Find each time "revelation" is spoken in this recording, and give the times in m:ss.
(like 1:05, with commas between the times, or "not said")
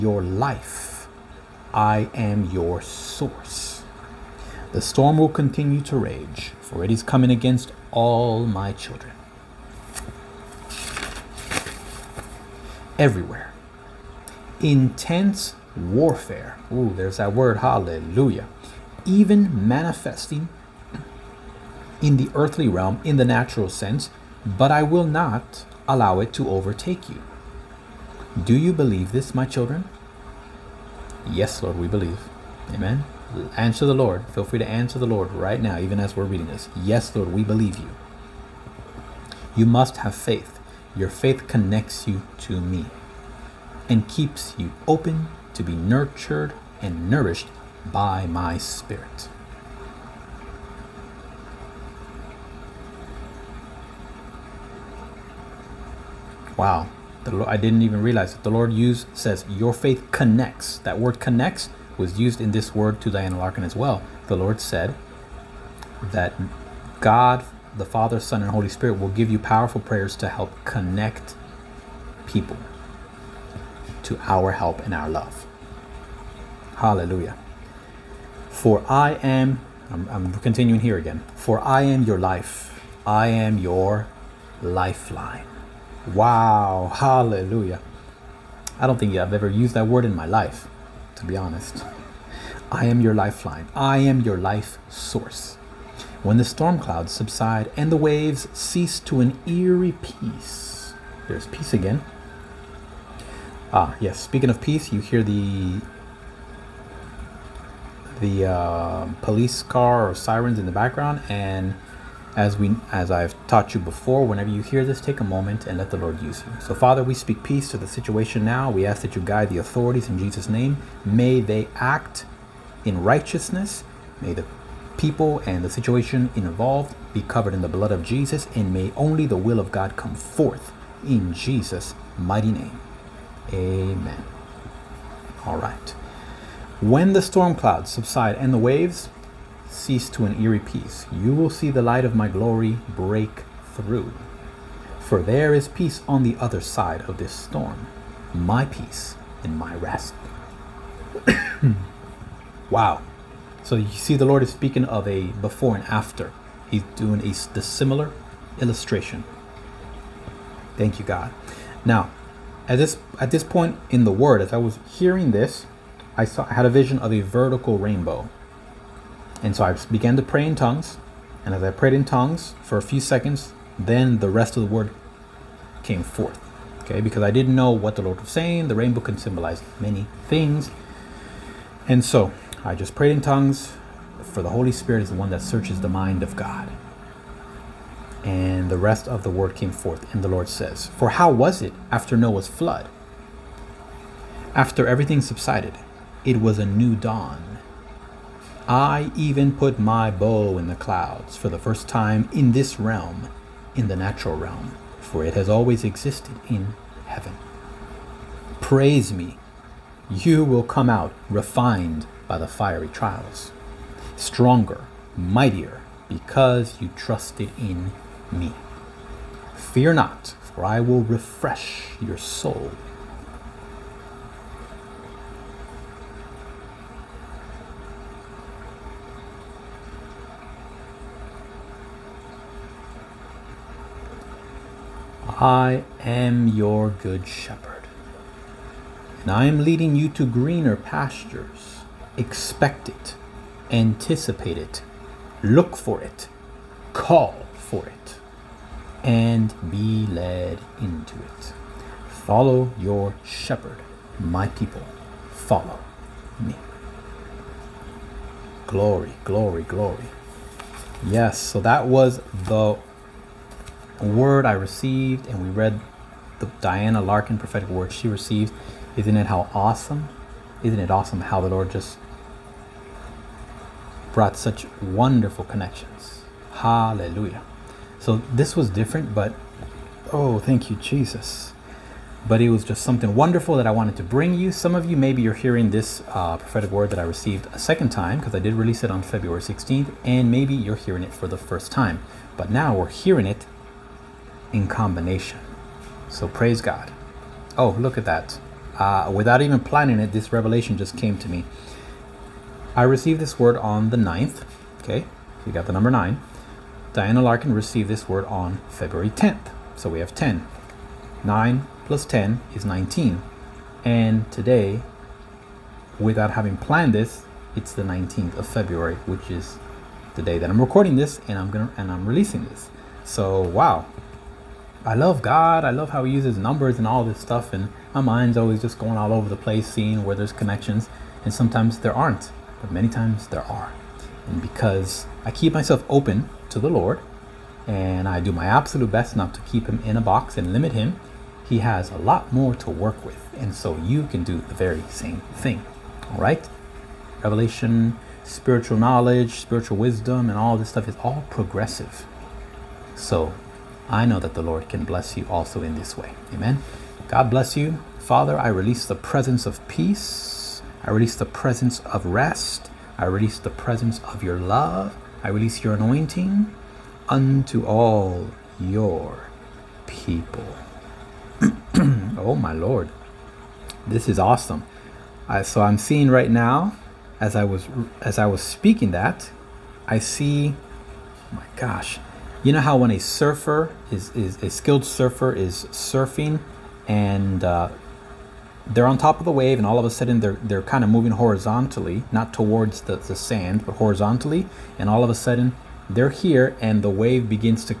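5:00, 5:47.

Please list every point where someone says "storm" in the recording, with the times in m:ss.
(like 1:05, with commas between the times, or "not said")
0:04, 1:36, 2:17, 2:27.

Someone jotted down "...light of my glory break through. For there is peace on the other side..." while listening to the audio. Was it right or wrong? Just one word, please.
right.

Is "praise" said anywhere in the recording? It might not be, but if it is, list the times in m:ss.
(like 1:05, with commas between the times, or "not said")
3:28, 4:56.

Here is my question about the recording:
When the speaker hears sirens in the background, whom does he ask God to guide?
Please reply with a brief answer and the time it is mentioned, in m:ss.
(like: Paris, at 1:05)
The authorities, at 1:59.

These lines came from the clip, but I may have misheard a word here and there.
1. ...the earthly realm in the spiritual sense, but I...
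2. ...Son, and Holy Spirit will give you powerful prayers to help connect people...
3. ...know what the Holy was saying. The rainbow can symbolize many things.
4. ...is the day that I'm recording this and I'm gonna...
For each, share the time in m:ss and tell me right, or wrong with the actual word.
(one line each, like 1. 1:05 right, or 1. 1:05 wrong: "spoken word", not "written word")
1. 0:22 wrong: "natural", not "spiritual"
2. 1:08 right
3. 2:57 wrong: "Lord", not "Holy"
4. 5:19 right.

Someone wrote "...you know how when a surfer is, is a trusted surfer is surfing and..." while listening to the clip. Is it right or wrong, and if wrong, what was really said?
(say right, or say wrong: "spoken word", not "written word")
wrong: "skilled", not "trusted".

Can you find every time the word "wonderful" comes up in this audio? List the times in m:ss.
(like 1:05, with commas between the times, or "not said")
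4:34, 4:43.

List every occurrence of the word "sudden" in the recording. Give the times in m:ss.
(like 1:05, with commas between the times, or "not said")
6:29, 6:35.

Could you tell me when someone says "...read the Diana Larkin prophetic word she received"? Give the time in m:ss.
4:25.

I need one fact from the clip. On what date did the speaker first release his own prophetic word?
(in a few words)
February 16th.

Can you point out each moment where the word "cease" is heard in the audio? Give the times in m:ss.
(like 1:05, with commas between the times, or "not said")
1:38, 2:19.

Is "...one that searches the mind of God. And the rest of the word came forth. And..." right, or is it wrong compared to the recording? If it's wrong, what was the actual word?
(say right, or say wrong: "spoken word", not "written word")
right.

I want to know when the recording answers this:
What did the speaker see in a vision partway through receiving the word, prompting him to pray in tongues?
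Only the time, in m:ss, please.
2:47.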